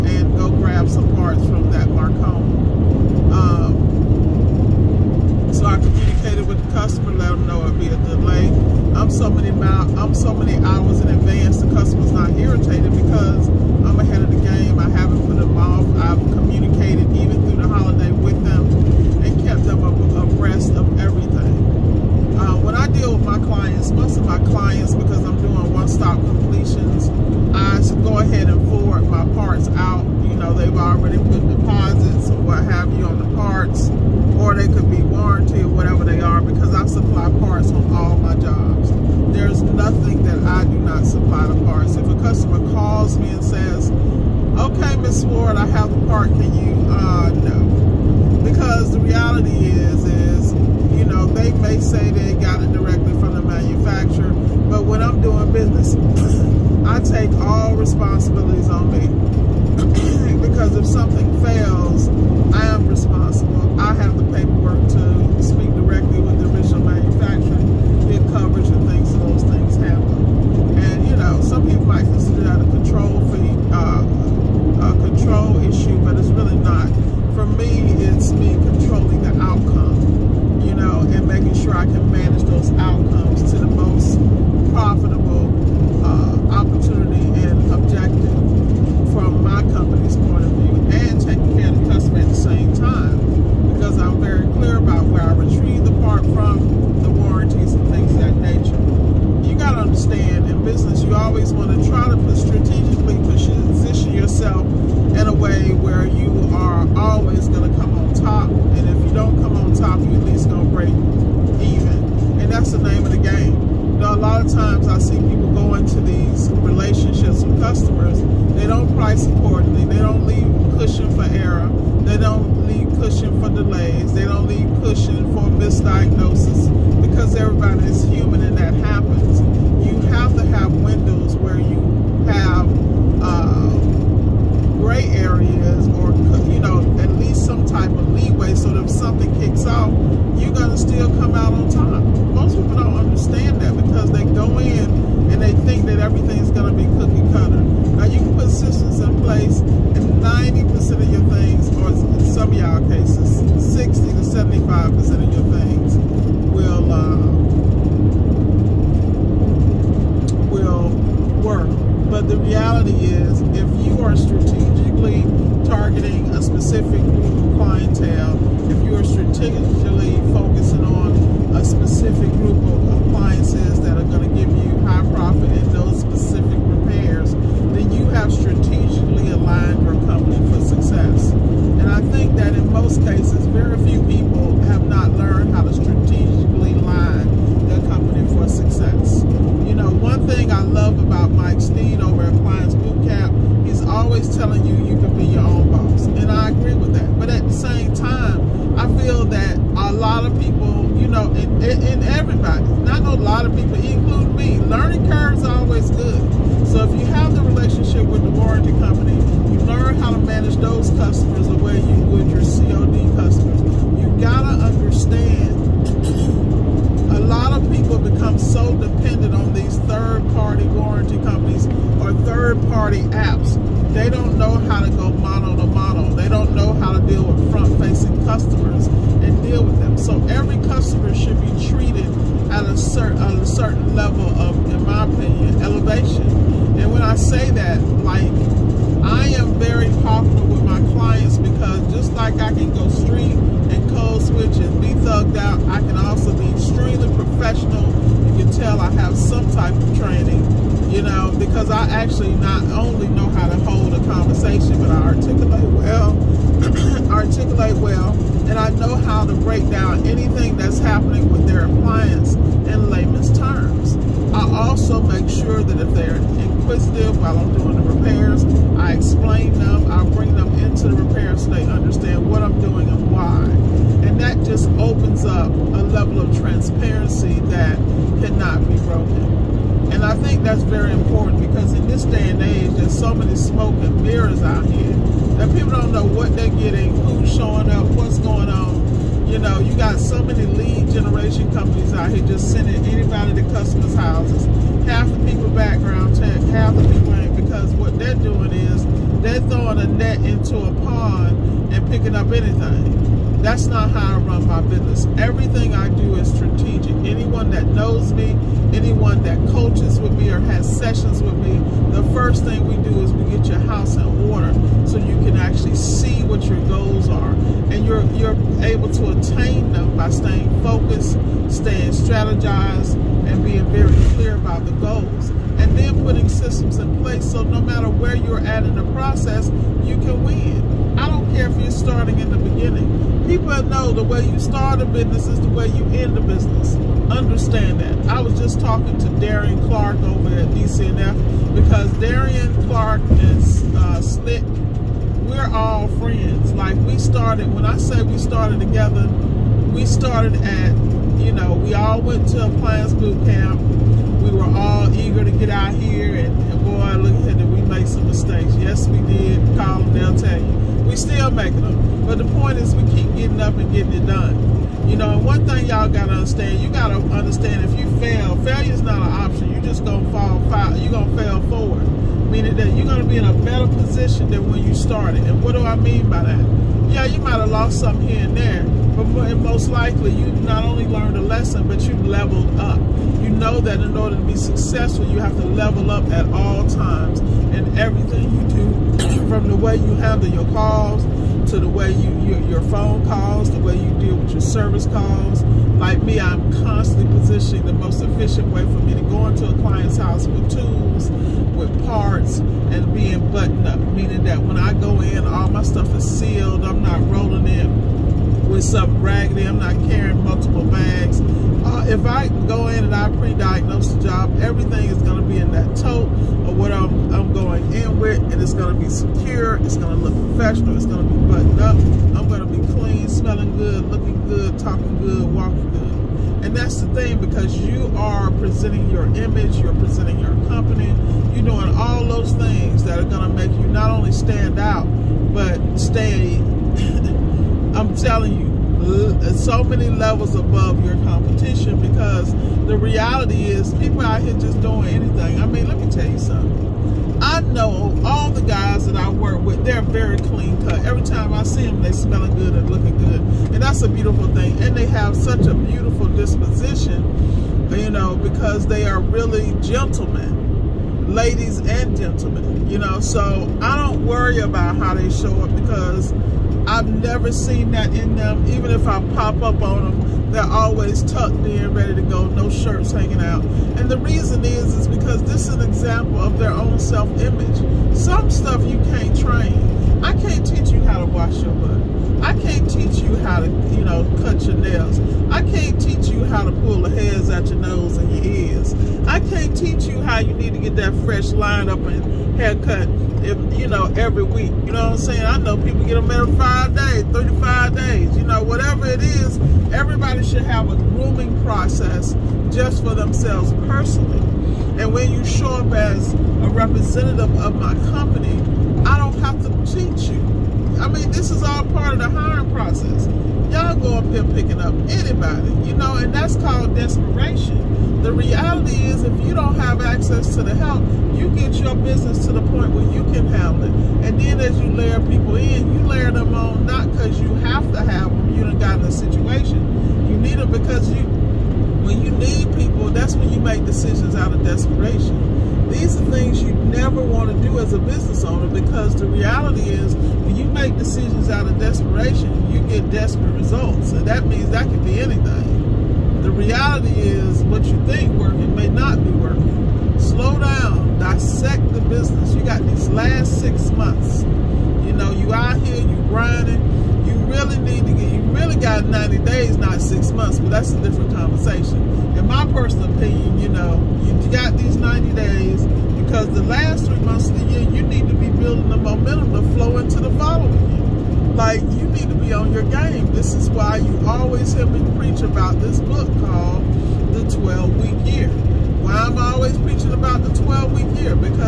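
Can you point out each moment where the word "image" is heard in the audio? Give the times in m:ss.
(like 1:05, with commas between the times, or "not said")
7:09, 7:56.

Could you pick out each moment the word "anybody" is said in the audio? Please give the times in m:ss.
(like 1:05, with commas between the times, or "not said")
4:52, 8:34.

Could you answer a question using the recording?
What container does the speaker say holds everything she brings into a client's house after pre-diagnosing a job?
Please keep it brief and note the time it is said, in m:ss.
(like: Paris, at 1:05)
Tote, at 6:55.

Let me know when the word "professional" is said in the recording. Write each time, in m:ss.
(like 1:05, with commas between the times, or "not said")
4:07, 7:00.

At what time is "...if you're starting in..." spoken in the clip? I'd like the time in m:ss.
5:31.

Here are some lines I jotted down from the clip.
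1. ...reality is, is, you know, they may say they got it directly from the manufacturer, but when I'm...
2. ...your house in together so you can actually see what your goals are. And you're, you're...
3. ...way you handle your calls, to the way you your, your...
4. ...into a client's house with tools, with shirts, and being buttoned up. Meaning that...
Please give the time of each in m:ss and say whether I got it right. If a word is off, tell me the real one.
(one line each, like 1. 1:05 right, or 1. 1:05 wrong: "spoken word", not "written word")
1. 0:48 right
2. 5:13 wrong: "order", not "together"
3. 6:29 right
4. 6:39 wrong: "parts", not "shirts".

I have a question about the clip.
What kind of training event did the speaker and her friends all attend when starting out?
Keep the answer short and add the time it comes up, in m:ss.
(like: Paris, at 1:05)
Plans Boot Camp, at 5:52.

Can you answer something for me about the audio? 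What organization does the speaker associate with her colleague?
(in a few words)
DCNF.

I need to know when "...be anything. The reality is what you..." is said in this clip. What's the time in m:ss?
9:04.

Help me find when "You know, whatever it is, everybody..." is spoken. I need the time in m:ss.
8:18.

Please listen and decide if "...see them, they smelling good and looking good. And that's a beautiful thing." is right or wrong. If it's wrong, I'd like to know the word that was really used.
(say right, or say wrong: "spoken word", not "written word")
right.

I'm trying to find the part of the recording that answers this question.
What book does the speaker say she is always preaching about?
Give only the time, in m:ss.
9:37.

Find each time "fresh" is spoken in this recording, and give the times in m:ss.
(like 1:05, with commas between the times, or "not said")
8:11.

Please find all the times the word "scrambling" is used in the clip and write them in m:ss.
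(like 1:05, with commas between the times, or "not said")
not said.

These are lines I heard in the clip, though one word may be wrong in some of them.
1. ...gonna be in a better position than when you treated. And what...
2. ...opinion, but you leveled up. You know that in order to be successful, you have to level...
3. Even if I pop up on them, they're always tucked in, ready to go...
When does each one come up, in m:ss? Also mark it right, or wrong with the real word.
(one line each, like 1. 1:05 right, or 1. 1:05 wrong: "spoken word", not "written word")
1. 6:12 wrong: "started", not "treated"
2. 6:21 wrong: "lesson", not "opinion"
3. 7:48 right.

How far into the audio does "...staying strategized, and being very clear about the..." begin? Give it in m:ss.
5:21.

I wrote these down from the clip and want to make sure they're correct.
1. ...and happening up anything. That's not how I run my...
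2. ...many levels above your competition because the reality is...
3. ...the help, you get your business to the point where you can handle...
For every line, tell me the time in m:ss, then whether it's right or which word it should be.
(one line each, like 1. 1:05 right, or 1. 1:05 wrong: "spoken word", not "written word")
1. 5:01 wrong: "picking", not "happening"
2. 7:19 right
3. 8:40 right.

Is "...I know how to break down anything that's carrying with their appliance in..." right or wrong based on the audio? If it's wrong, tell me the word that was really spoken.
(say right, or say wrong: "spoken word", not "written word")
wrong: "happening", not "carrying".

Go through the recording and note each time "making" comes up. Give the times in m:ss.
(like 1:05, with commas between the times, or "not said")
1:21, 6:01.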